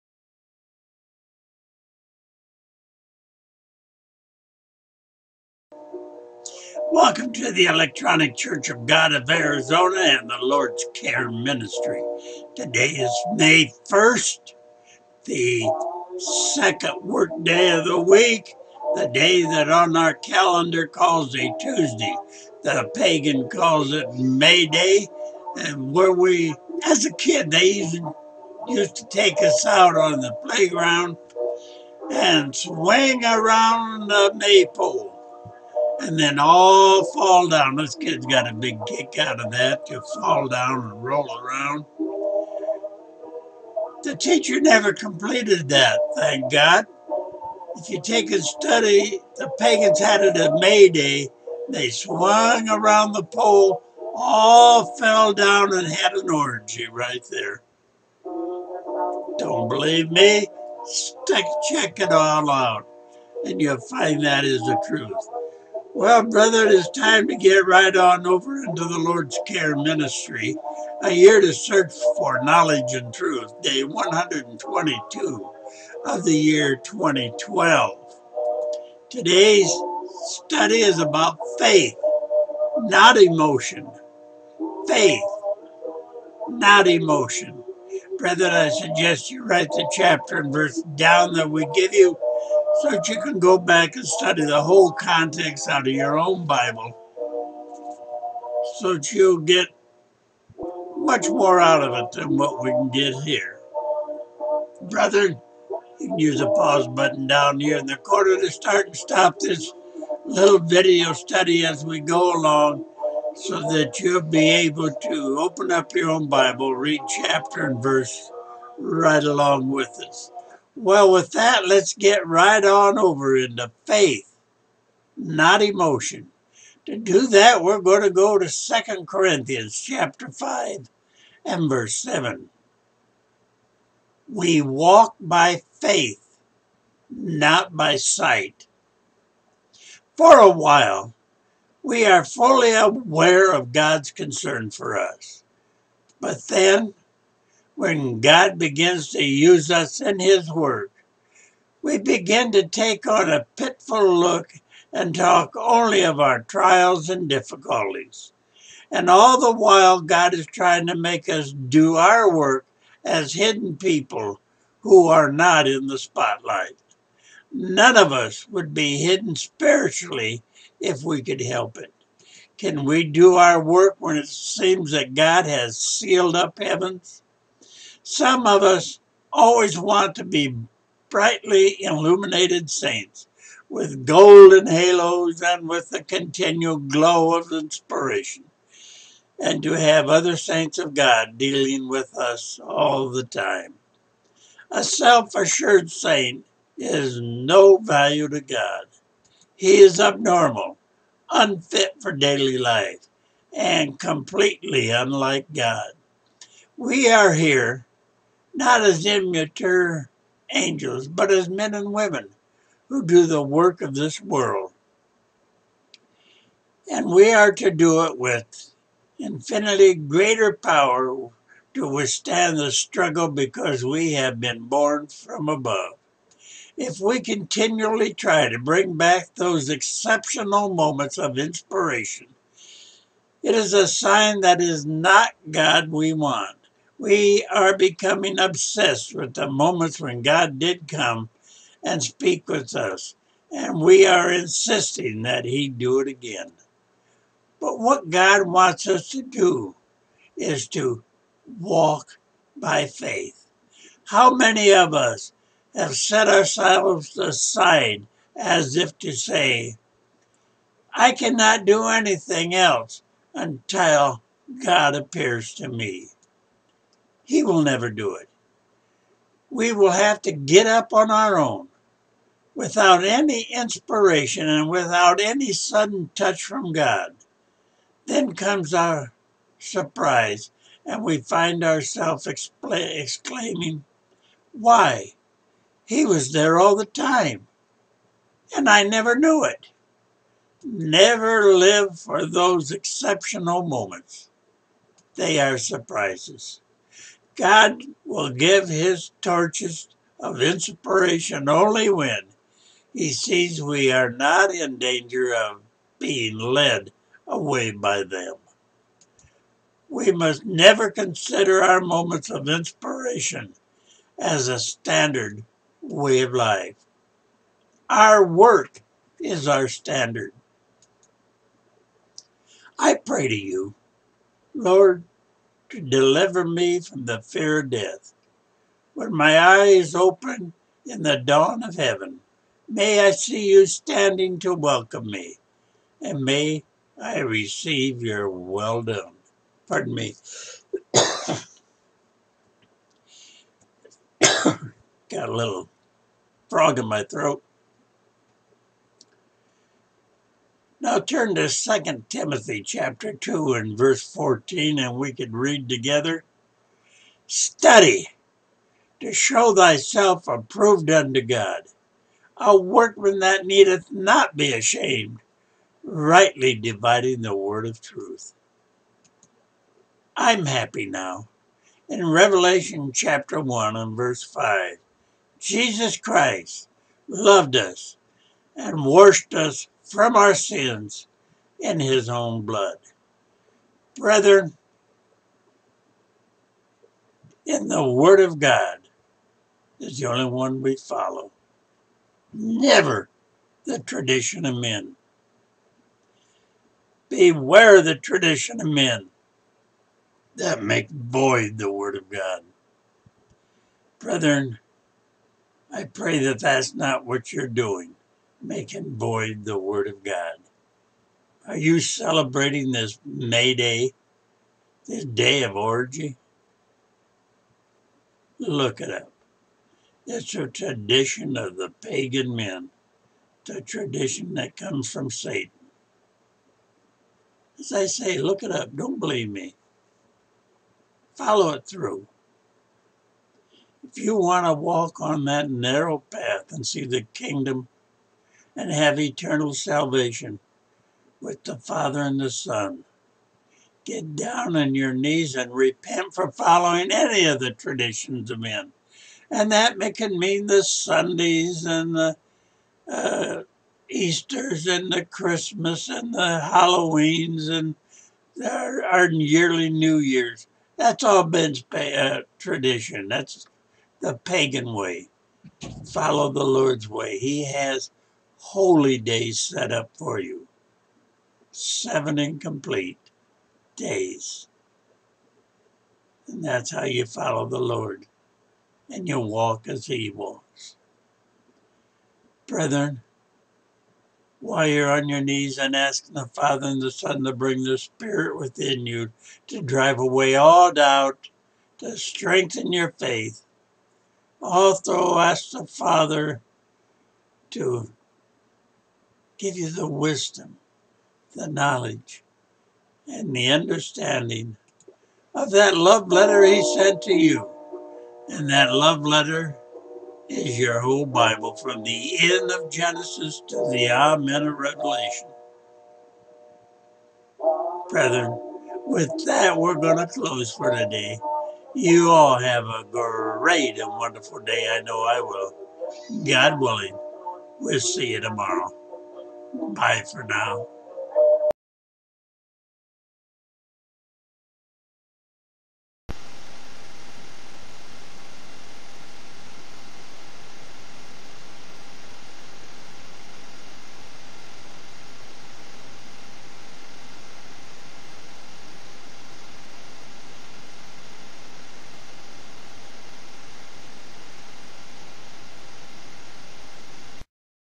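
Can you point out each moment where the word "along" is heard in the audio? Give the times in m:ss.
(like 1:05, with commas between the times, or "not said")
1:52, 1:59.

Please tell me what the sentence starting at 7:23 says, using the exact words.
Get down on your knees and repent for following any of the traditions of men.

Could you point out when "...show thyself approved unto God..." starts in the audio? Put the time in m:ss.
5:59.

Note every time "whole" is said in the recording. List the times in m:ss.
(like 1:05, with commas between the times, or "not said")
1:34, 8:30.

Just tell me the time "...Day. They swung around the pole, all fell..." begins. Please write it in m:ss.
0:50.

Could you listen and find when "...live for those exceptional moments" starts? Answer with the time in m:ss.
4:51.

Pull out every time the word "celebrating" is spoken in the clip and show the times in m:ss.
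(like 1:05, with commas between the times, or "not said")
6:51.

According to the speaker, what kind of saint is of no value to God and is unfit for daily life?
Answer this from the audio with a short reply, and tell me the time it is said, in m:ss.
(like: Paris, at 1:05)
A self assured saint, at 3:14.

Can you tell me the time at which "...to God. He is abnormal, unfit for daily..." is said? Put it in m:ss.
3:18.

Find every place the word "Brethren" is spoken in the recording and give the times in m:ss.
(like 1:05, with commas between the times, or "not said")
6:23, 6:43, 8:02, 8:37.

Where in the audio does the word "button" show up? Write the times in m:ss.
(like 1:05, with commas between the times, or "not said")
1:46.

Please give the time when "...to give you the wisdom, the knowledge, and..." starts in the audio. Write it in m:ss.
8:17.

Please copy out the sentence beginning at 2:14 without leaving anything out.
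We walk by faith, not by sight.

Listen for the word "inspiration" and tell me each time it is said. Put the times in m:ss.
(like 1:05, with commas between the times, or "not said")
3:07, 3:51, 4:33, 5:00, 5:12.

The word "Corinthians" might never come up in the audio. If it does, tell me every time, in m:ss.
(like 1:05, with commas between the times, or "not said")
2:09.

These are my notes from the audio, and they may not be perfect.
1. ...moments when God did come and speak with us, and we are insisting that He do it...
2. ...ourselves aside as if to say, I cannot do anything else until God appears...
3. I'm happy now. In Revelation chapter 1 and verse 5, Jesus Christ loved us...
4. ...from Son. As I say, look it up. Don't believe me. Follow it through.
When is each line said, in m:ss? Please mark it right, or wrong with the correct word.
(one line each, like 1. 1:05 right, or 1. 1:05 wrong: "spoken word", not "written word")
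1. 3:59 right
2. 4:16 right
3. 6:10 right
4. 7:04 wrong: "Satan", not "Son".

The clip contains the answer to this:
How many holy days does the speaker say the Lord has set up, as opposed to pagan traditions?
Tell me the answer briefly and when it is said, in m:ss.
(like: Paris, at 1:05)
7, at 7:51.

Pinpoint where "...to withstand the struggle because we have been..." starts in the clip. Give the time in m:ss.
3:41.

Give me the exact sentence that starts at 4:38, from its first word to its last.
Then comes our surprise, and we find ourselves exclaiming, Why?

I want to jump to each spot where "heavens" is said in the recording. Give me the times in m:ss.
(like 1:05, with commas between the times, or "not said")
2:56, 5:31.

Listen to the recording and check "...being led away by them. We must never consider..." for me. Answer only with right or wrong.
right.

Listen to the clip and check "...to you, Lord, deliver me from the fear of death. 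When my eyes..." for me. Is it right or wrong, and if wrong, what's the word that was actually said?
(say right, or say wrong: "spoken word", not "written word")
right.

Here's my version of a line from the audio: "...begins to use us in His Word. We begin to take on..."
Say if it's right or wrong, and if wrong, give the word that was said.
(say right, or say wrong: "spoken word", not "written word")
right.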